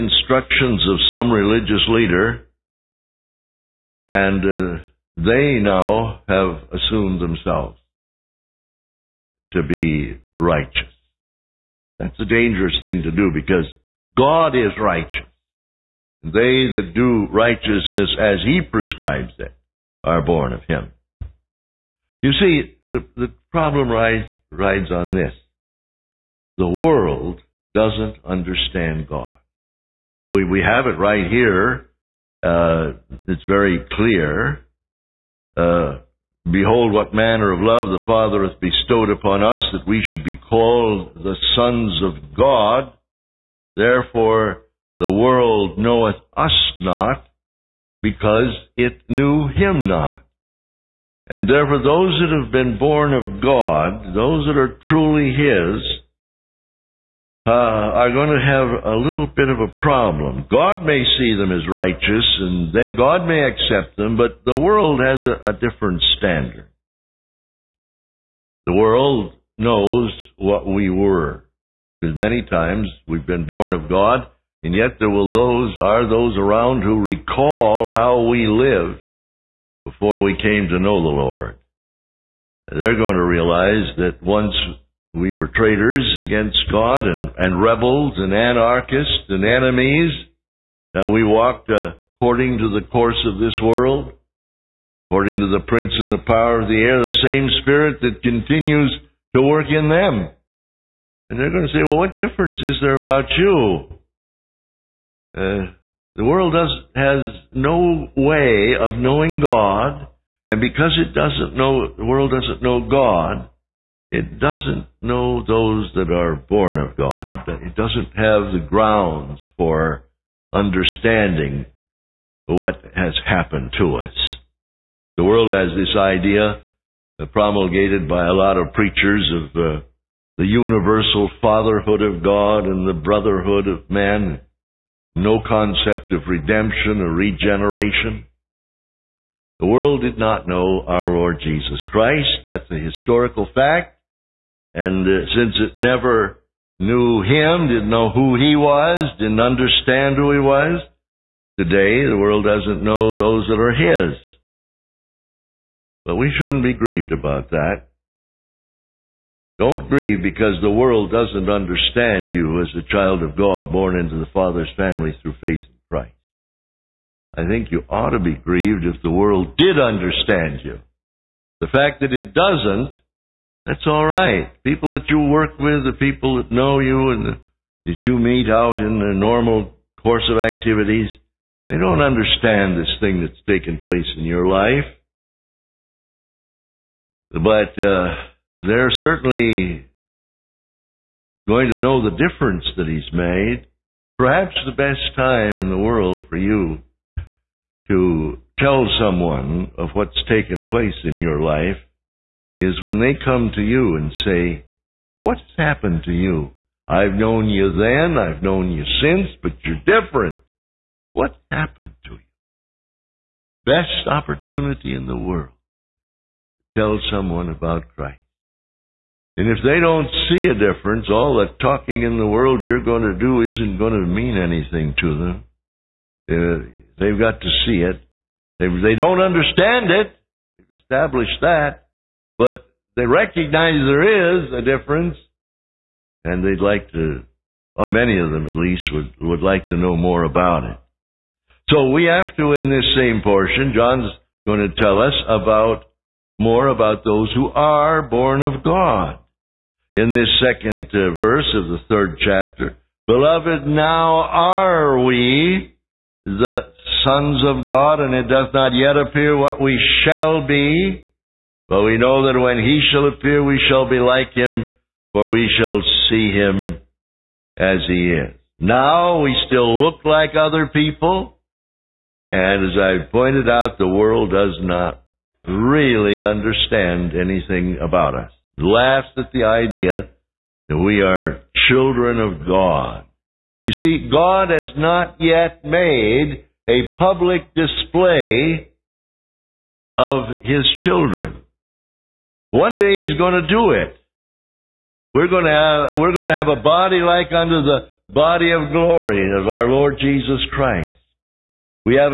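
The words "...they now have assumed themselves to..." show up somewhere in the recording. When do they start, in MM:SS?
00:05.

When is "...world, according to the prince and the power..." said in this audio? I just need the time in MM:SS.
01:33.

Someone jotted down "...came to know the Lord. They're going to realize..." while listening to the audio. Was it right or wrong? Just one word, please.
right.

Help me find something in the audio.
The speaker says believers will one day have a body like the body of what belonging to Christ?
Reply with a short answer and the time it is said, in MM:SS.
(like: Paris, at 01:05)
glory, at 04:58.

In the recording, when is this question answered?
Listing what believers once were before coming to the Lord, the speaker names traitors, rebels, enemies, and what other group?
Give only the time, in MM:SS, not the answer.
01:28.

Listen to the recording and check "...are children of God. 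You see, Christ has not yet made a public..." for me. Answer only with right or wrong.
wrong.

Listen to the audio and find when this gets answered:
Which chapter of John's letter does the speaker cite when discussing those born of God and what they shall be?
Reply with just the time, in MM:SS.
04:11.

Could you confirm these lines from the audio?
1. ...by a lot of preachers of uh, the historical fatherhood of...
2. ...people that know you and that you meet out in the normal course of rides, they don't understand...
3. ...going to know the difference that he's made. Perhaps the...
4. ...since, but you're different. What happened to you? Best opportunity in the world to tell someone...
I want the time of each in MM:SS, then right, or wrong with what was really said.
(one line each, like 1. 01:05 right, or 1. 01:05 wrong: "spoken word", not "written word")
1. 02:08 wrong: "universal", not "historical"
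2. 02:55 wrong: "activities", not "rides"
3. 03:11 right
4. 03:29 right.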